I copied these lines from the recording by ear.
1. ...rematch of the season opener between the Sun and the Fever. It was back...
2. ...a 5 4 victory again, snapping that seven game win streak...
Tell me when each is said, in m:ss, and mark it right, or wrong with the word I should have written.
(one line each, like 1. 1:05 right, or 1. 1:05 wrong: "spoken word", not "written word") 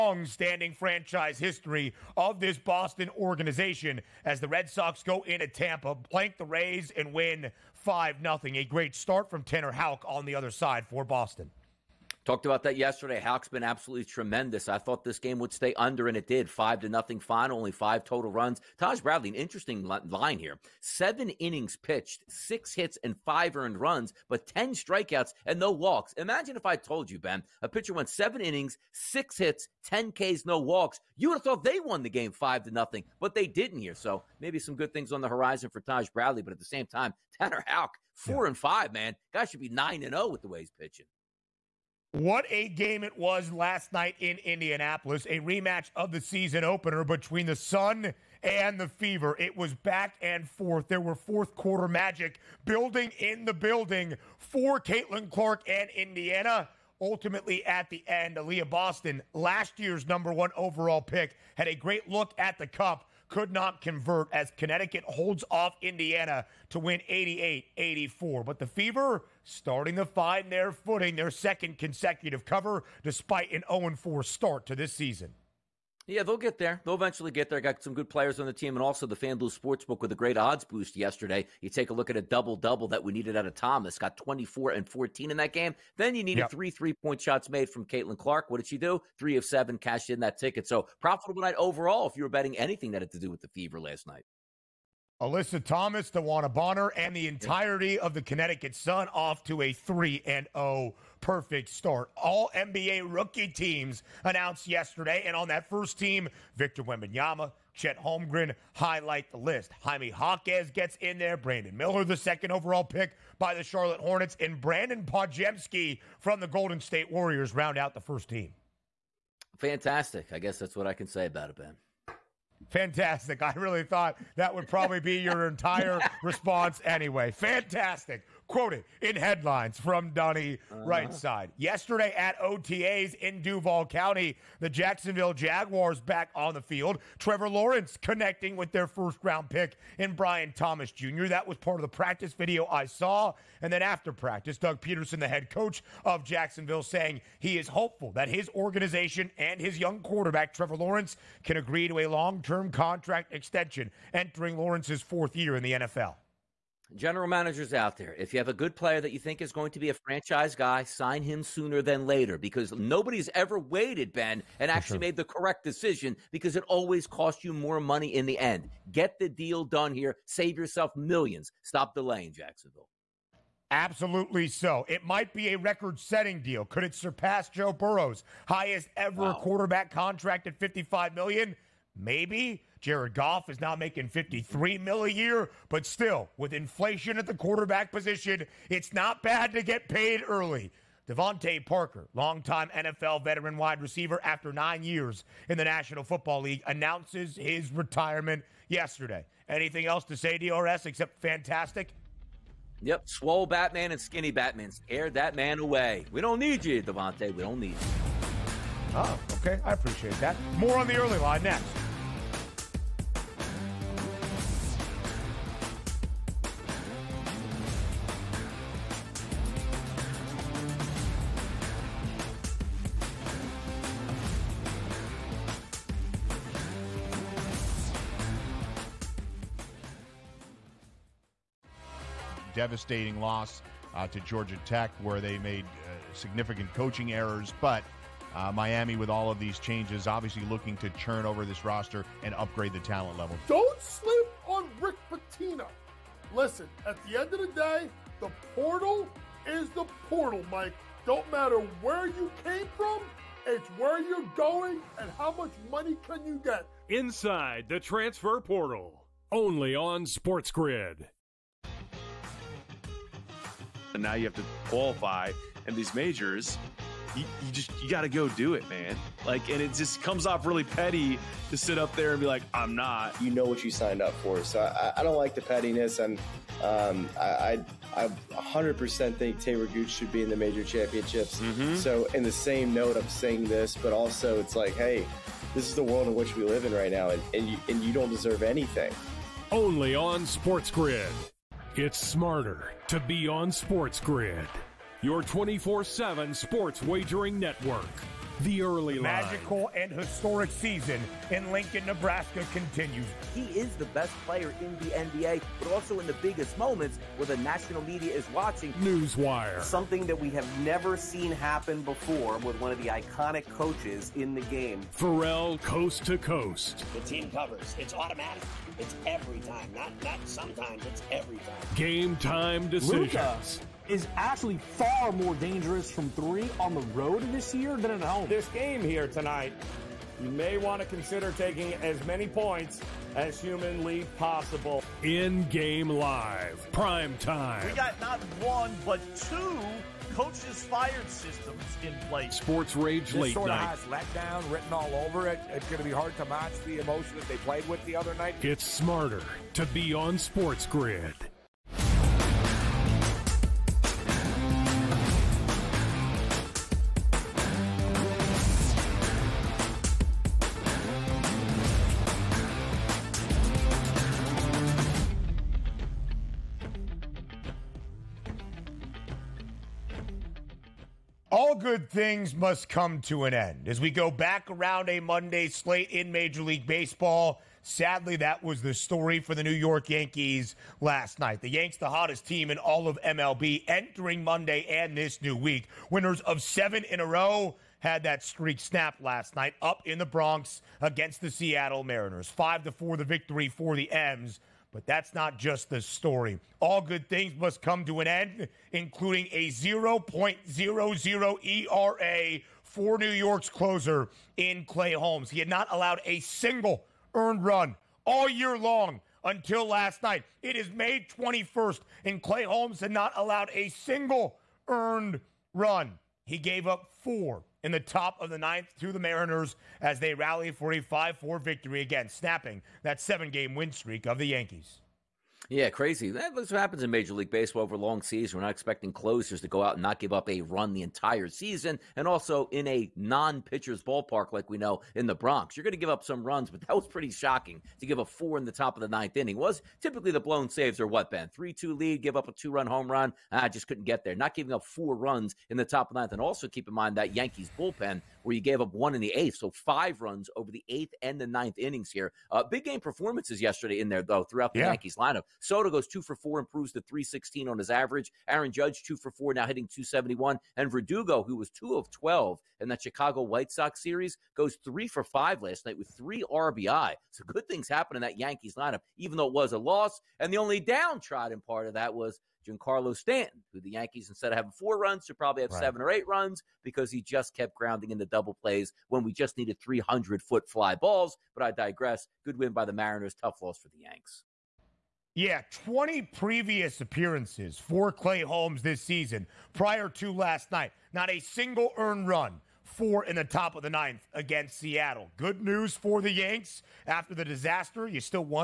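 1. 0:45 right
2. 7:00 right.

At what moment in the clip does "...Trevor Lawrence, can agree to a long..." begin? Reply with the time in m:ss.
2:30.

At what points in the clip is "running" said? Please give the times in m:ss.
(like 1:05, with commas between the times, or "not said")
not said.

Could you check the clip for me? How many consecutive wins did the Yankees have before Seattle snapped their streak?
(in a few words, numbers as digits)
7.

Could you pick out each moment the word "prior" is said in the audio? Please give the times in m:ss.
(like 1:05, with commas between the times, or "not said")
8:09.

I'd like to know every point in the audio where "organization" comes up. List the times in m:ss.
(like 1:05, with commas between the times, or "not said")
0:03, 2:28.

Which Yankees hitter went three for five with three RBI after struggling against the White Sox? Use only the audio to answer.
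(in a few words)
Verdugo.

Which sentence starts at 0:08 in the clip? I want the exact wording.
A great start from Tanner Houck on the other side for Boston.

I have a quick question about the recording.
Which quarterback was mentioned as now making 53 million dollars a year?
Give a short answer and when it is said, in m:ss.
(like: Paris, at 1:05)
Jared Goff, at 3:02.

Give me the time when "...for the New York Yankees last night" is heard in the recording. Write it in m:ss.
6:19.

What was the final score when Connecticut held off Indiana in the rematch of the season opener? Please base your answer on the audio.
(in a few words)
88-84.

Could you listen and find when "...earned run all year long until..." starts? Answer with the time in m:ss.
6:47.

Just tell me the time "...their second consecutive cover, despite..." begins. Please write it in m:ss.
1:11.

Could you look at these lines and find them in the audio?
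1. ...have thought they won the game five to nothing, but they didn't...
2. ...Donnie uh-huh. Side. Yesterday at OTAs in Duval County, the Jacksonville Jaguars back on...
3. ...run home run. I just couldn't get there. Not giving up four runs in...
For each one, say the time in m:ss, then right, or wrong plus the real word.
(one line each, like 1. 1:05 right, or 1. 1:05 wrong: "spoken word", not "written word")
1. 0:31 right
2. 2:10 right
3. 7:22 right.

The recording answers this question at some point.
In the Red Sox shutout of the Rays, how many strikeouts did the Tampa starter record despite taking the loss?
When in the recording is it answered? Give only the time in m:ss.
0:24.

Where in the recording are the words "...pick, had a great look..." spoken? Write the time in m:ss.
1:01.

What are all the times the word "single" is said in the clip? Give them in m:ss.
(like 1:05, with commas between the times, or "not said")
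6:46, 6:53, 8:11.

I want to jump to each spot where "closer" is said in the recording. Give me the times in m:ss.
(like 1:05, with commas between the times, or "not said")
6:43, 7:08.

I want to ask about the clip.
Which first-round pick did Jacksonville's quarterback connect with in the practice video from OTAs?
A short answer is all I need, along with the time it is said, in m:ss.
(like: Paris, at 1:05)
Brian Thomas Jr., at 2:20.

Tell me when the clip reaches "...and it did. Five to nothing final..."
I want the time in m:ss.
0:16.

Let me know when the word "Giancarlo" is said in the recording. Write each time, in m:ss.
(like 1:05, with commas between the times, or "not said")
7:52.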